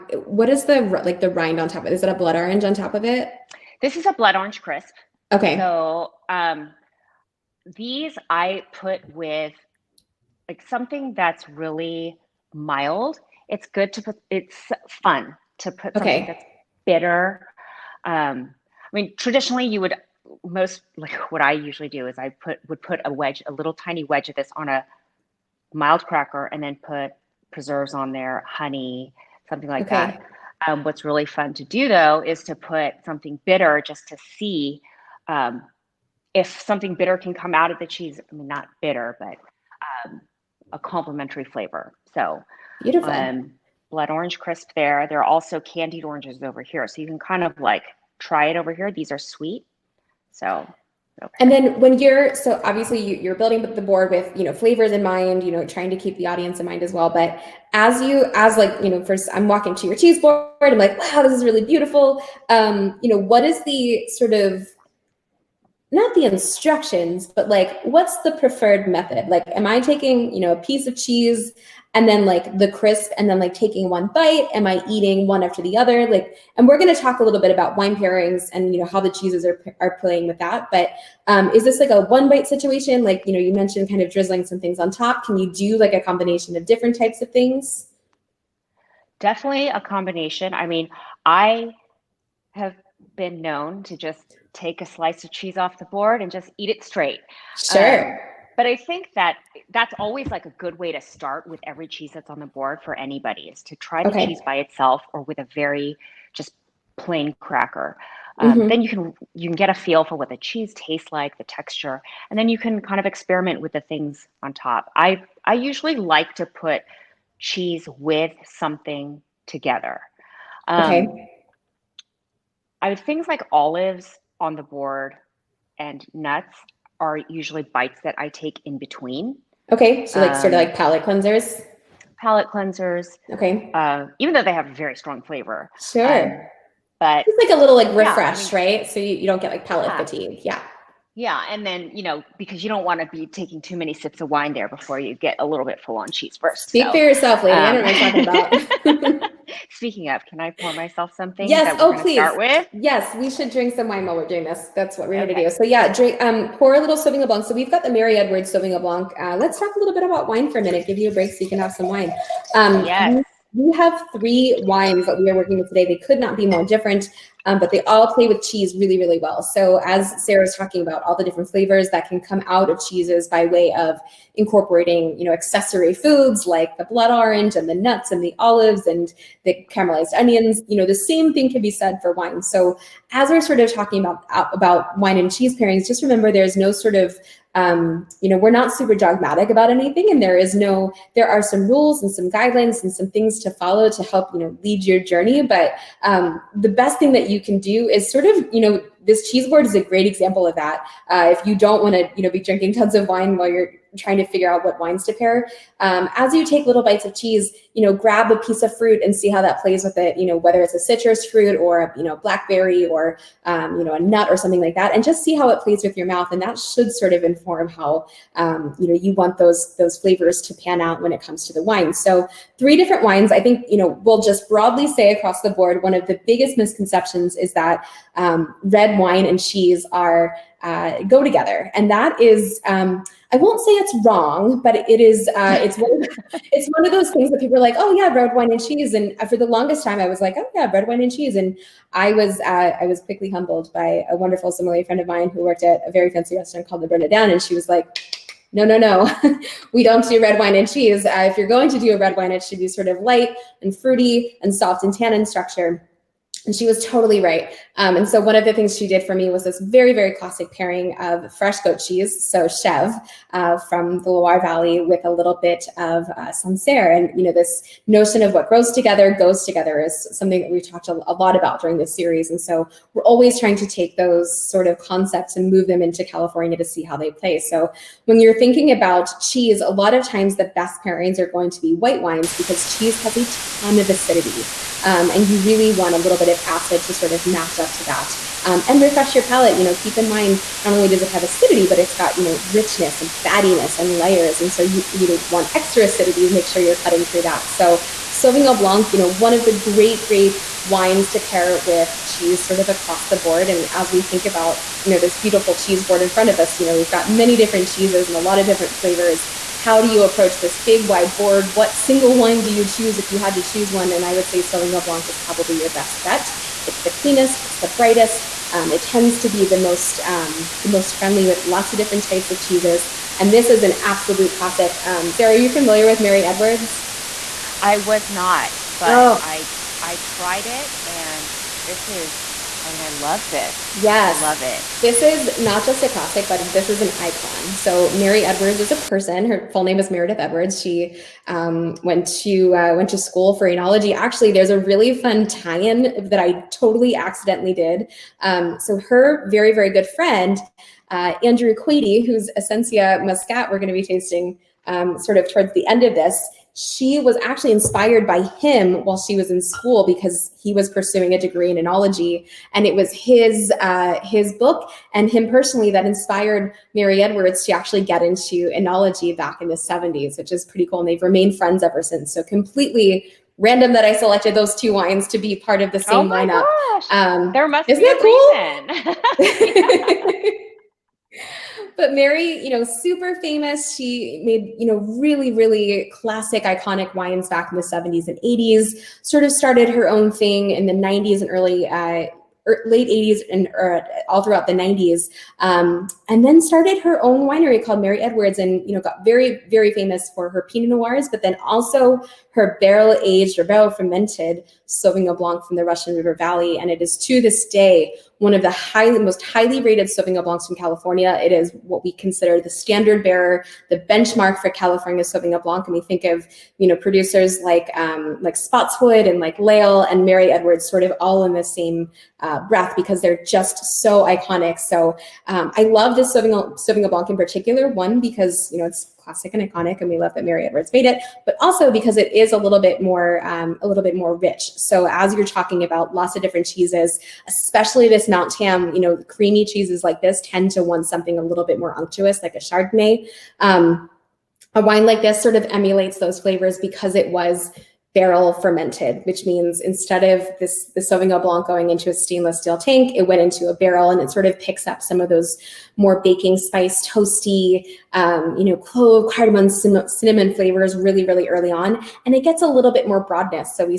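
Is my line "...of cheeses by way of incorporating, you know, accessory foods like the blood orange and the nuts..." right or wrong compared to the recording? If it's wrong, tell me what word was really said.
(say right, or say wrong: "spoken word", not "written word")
right.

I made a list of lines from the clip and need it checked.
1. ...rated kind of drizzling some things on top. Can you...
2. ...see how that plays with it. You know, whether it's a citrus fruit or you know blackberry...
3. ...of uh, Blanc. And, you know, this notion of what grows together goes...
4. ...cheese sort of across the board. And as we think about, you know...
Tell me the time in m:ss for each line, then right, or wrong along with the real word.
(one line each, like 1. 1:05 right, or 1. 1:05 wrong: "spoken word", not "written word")
1. 1:23 wrong: "mentioned", not "rated"
2. 3:29 right
3. 4:25 wrong: "Sancerre", not "Blanc"
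4. 5:02 right.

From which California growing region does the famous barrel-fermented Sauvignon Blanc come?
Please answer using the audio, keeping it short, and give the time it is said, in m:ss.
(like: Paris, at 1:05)
Russian River Valley, at 6:45.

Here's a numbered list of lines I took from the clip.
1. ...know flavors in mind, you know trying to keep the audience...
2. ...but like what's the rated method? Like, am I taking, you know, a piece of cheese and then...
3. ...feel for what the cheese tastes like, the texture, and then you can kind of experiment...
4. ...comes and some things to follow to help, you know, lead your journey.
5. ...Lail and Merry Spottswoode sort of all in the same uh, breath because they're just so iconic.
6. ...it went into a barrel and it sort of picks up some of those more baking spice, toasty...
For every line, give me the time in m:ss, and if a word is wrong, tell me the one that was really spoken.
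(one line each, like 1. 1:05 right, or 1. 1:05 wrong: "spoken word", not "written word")
1. 0:54 right
2. 1:07 wrong: "preferred", not "rated"
3. 1:49 right
4. 3:12 wrong: "guidelines", not "comes"
5. 6:59 wrong: "Edwards", not "Spottswoode"
6. 7:32 right.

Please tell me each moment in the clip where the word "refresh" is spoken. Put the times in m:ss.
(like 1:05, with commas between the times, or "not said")
2:17, 4:48.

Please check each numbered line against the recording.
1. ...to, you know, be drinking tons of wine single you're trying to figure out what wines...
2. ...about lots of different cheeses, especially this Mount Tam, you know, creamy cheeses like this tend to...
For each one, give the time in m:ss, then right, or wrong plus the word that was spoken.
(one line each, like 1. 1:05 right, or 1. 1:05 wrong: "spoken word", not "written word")
1. 3:21 wrong: "while", not "single"
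2. 7:15 right.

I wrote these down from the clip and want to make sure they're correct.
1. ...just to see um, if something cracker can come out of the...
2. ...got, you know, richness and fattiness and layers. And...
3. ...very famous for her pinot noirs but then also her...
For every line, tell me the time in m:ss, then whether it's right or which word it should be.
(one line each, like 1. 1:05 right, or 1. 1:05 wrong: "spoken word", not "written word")
1. 0:33 wrong: "bitter", not "cracker"
2. 4:51 right
3. 6:39 right.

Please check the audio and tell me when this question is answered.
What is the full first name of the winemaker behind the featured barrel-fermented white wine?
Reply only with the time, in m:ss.
5:39.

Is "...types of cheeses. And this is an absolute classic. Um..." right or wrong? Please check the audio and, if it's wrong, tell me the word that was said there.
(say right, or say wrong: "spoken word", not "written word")
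right.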